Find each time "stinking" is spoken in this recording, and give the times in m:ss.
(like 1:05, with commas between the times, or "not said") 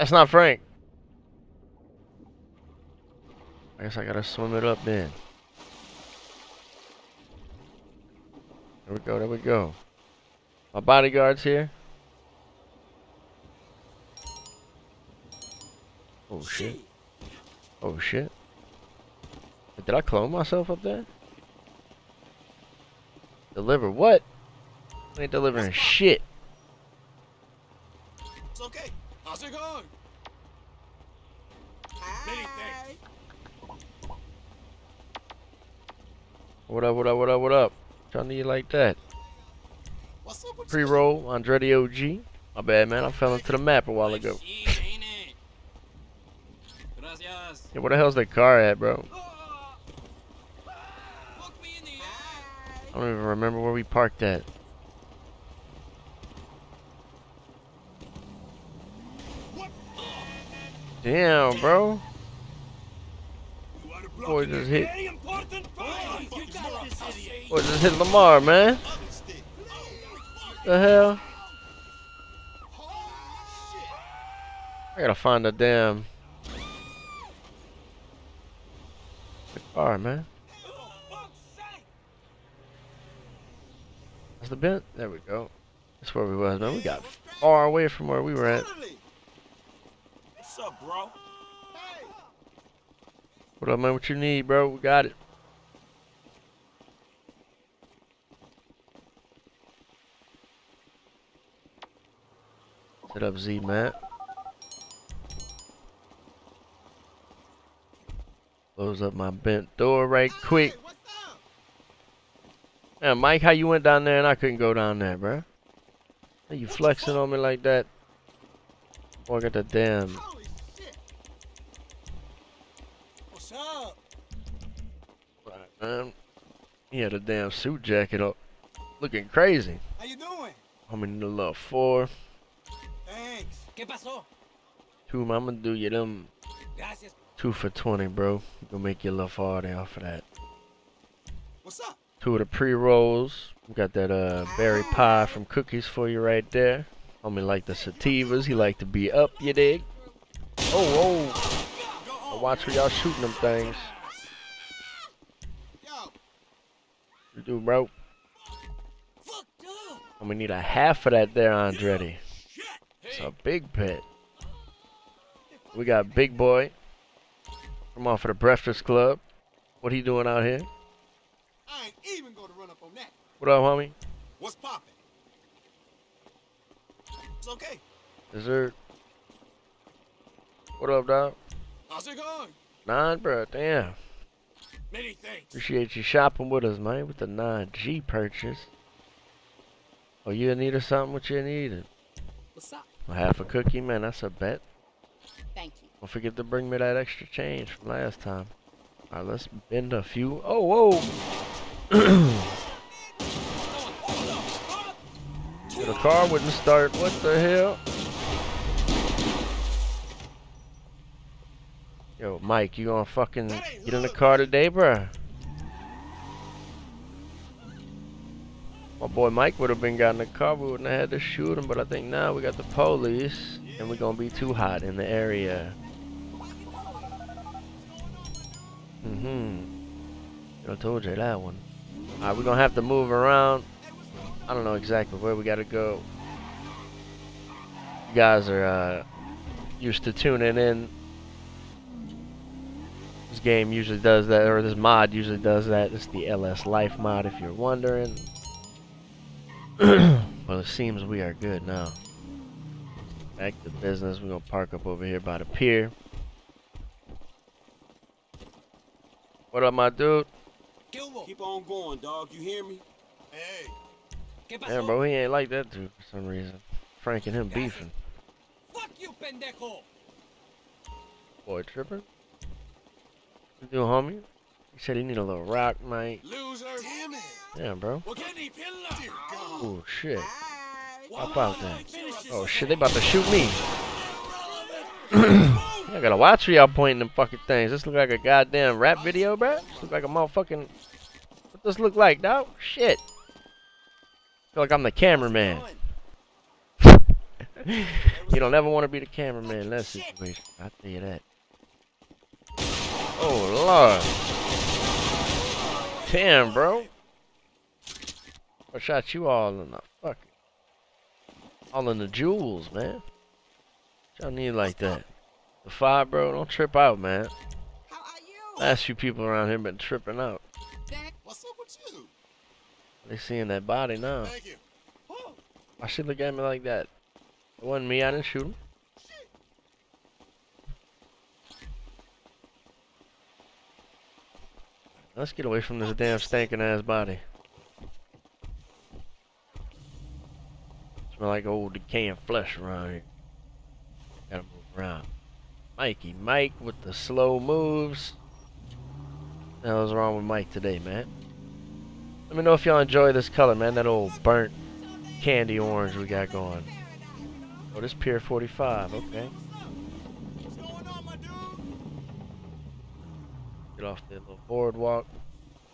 5:36.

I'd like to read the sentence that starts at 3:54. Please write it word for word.
I don't know exactly where we gotta go.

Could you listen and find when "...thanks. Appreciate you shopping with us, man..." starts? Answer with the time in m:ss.
3:05.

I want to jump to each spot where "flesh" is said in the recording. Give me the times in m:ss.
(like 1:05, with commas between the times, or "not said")
5:42.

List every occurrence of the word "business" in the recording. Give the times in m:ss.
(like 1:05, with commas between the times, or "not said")
4:13.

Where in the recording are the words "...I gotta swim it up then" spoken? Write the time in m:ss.
0:03.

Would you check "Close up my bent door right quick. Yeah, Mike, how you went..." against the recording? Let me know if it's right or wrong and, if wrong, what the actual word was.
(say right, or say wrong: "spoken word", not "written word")
right.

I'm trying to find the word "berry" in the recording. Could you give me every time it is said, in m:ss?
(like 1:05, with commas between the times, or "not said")
2:24.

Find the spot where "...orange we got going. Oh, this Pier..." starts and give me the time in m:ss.
5:55.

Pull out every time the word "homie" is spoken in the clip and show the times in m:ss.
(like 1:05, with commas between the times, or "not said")
2:27, 2:53, 4:33.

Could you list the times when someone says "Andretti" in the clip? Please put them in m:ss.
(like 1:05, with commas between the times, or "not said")
0:41, 2:41.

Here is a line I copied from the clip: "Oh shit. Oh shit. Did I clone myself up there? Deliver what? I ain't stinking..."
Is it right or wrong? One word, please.
wrong.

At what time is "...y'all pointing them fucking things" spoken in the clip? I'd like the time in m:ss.
4:46.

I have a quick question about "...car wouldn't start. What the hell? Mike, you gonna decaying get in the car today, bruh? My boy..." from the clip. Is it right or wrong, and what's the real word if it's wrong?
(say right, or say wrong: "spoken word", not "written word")
wrong: "fucking", not "decaying".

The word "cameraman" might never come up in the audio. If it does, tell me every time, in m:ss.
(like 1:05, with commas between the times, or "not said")
4:54, 4:59.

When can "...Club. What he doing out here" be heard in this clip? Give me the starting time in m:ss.
2:48.